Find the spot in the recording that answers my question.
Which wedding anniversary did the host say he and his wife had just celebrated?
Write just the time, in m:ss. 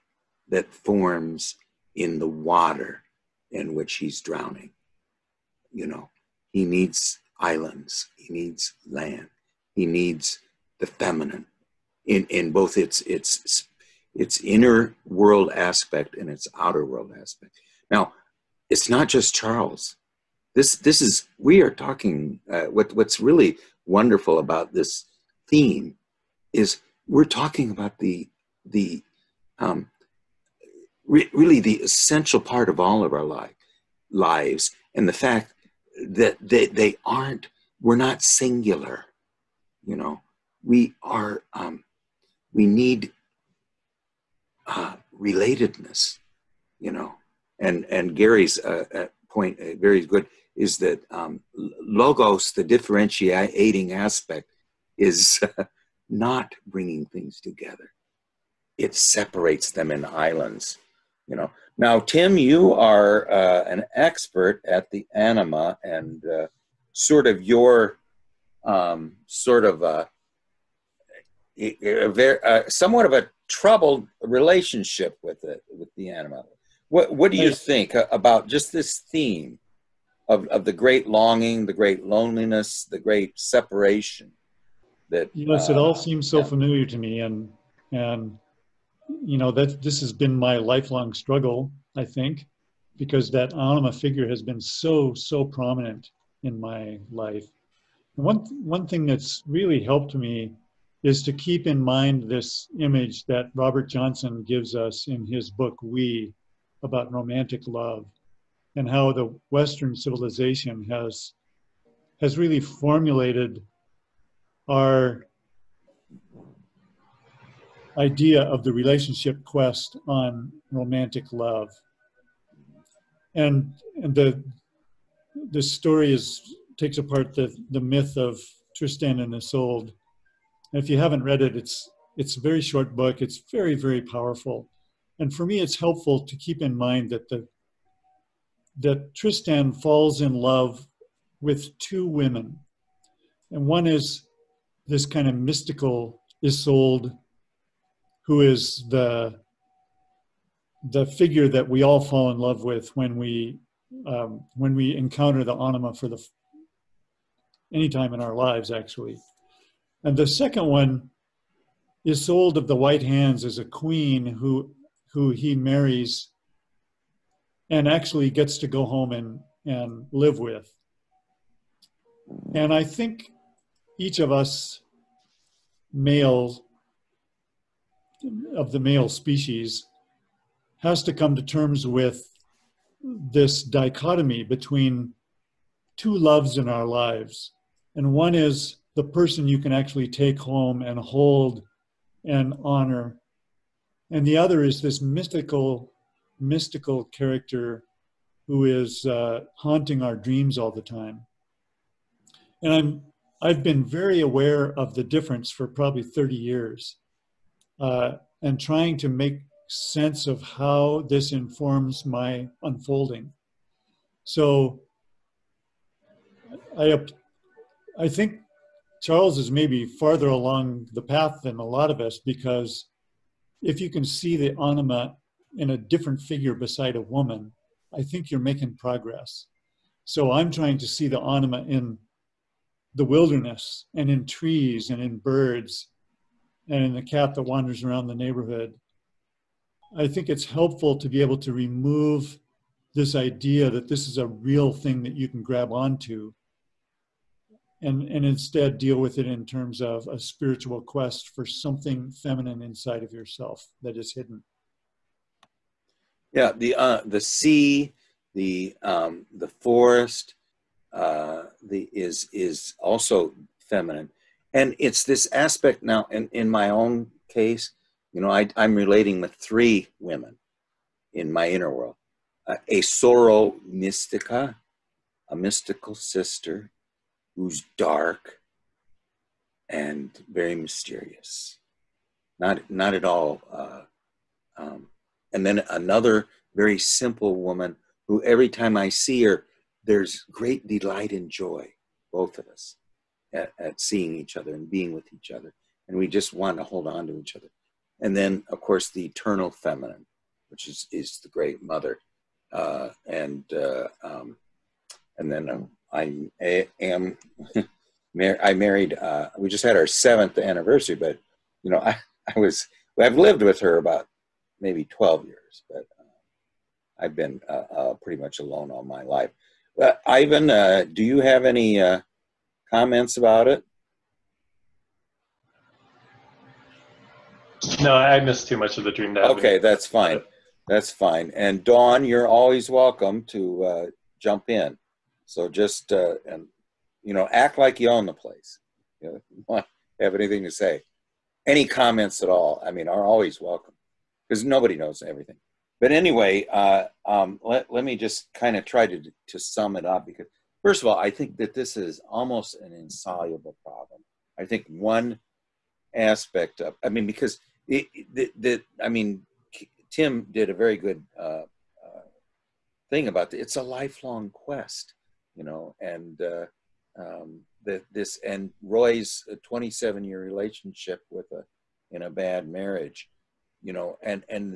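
5:09.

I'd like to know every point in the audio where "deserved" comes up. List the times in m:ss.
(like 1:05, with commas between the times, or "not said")
not said.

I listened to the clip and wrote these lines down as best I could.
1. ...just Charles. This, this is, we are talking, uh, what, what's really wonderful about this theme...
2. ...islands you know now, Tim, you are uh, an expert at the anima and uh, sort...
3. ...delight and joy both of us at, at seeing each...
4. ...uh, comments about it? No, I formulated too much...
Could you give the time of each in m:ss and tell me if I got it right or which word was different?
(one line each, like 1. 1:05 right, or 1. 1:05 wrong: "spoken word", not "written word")
1. 0:19 right
2. 1:00 right
3. 4:50 right
4. 5:21 wrong: "missed", not "formulated".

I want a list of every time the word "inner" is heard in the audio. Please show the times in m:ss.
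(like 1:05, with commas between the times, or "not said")
0:14, 4:31.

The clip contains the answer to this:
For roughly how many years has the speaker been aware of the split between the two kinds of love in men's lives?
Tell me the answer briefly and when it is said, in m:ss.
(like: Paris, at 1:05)
30, at 3:26.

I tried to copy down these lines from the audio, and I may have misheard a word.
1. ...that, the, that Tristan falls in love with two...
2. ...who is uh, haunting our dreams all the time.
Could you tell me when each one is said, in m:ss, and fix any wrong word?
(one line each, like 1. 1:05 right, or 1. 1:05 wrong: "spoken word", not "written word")
1. 2:17 right
2. 3:18 right.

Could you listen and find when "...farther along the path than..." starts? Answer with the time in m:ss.
3:39.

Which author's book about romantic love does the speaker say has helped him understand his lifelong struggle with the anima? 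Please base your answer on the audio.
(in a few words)
Robert Johnson.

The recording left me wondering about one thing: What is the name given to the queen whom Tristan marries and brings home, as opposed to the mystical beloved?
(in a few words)
Isolde of the white hands.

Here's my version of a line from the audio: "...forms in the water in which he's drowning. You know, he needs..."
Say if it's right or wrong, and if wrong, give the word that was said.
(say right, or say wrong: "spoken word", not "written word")
right.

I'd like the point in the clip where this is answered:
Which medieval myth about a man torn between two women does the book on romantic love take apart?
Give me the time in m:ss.
2:08.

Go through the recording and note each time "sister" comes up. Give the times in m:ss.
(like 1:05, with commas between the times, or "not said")
4:35.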